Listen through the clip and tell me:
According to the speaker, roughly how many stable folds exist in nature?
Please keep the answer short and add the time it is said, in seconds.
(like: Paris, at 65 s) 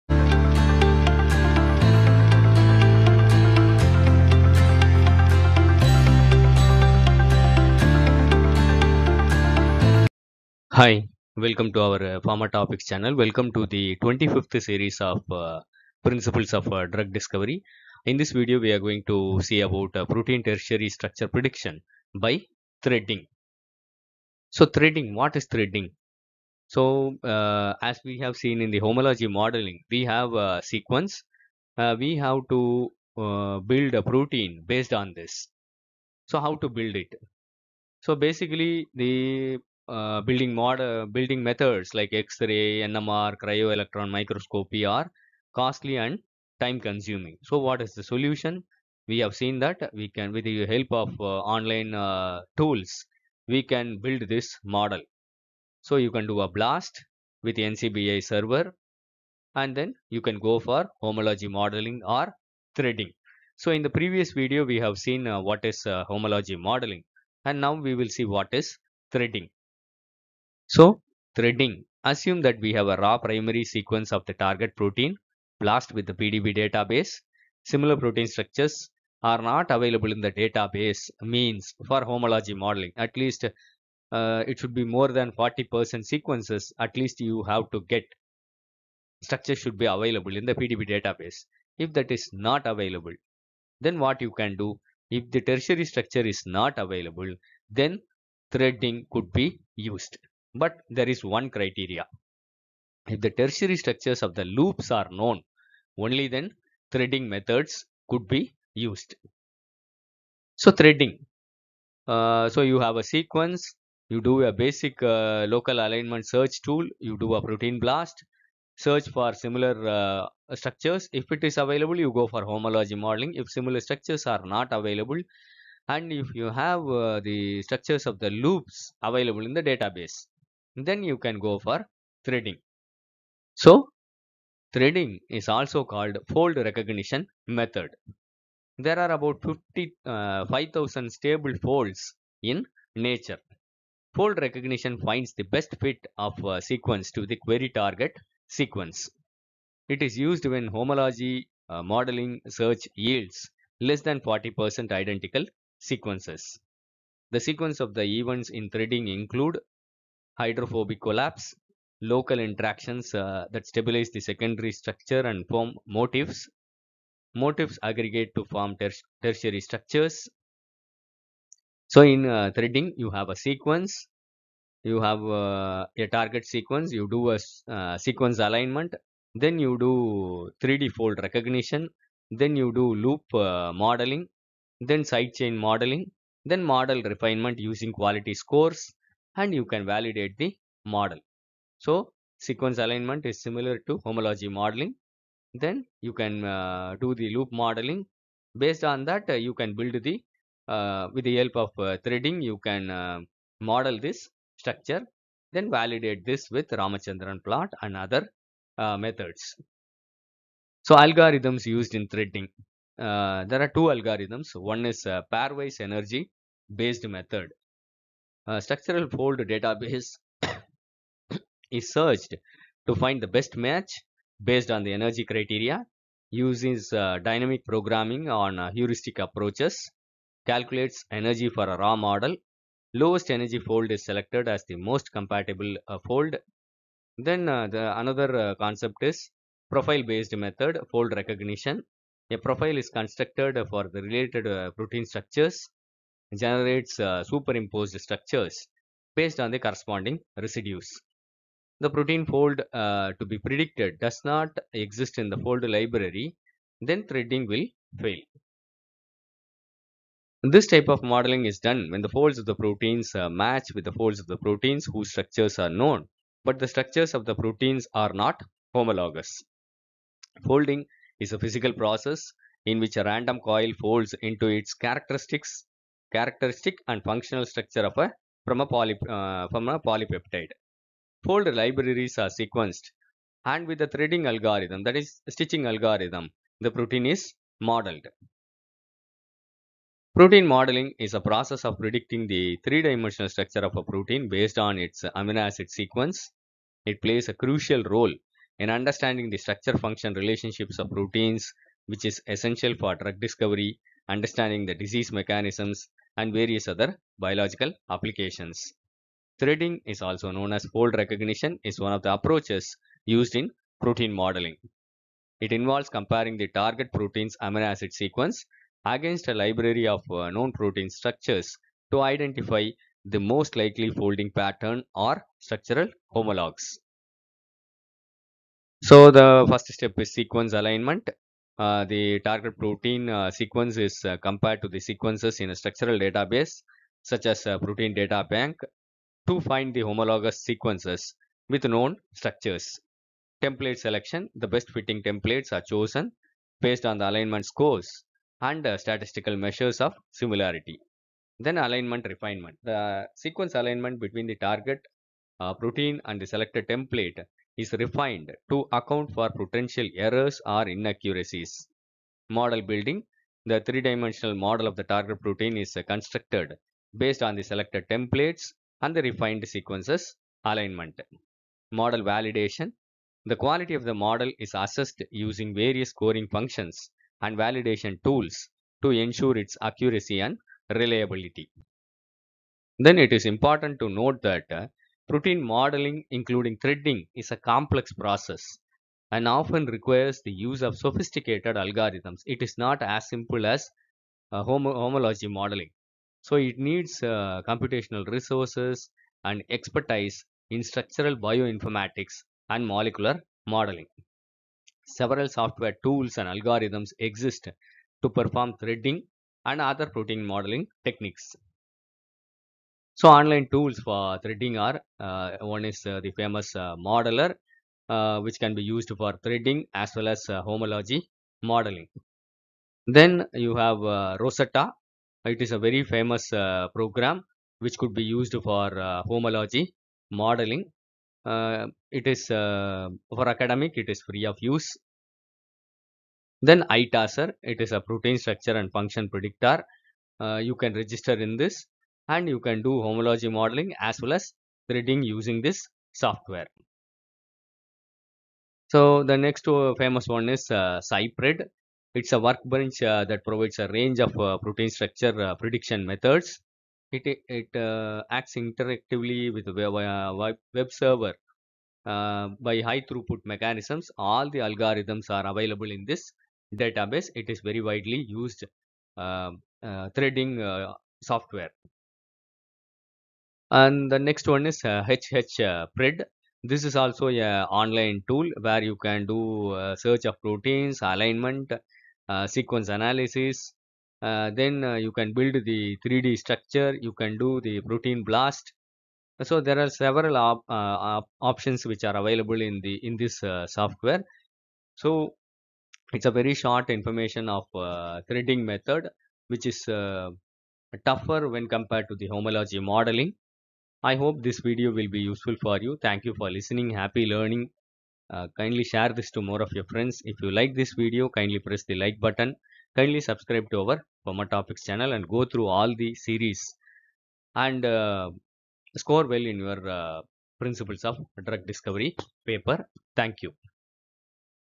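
5000, at 140 s.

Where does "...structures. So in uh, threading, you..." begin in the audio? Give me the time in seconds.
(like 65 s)
169 s.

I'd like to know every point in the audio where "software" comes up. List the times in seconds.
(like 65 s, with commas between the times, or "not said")
405 s, 446 s, 471 s, 493 s.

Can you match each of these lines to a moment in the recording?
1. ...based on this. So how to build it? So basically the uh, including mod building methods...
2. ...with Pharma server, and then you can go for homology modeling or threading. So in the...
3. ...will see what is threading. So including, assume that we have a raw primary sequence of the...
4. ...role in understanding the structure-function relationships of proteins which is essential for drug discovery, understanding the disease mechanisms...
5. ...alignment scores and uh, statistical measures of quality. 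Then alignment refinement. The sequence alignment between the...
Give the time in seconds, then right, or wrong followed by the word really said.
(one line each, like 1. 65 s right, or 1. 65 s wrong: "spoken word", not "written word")
1. 34 s wrong: "building", not "including"
2. 57 s wrong: "NCBI", not "Pharma"
3. 67 s wrong: "threading", not "including"
4. 297 s right
5. 347 s wrong: "similarity", not "quality".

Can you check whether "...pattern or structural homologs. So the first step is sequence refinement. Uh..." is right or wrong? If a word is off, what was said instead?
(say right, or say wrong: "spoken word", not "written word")
wrong: "alignment", not "refinement".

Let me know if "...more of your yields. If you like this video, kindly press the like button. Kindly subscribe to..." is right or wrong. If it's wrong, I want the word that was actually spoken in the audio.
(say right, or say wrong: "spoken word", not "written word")
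wrong: "friends", not "yields".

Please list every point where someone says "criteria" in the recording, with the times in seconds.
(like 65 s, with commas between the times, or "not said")
101 s, 225 s.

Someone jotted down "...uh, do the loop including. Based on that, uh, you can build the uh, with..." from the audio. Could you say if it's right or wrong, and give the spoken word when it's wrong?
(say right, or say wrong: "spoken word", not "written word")
wrong: "modeling", not "including".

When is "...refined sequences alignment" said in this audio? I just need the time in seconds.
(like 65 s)
369 s.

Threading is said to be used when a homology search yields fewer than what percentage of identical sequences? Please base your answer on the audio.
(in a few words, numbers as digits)
40%.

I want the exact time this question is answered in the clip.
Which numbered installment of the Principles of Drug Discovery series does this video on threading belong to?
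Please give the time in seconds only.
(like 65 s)
14 s.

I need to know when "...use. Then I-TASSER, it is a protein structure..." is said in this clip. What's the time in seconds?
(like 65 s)
434 s.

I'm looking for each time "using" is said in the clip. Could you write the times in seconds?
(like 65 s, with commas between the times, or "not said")
187 s, 375 s, 445 s.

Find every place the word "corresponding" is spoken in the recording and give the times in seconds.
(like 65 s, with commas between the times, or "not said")
249 s.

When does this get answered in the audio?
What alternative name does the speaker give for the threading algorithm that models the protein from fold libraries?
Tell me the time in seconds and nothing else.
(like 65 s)
285 s.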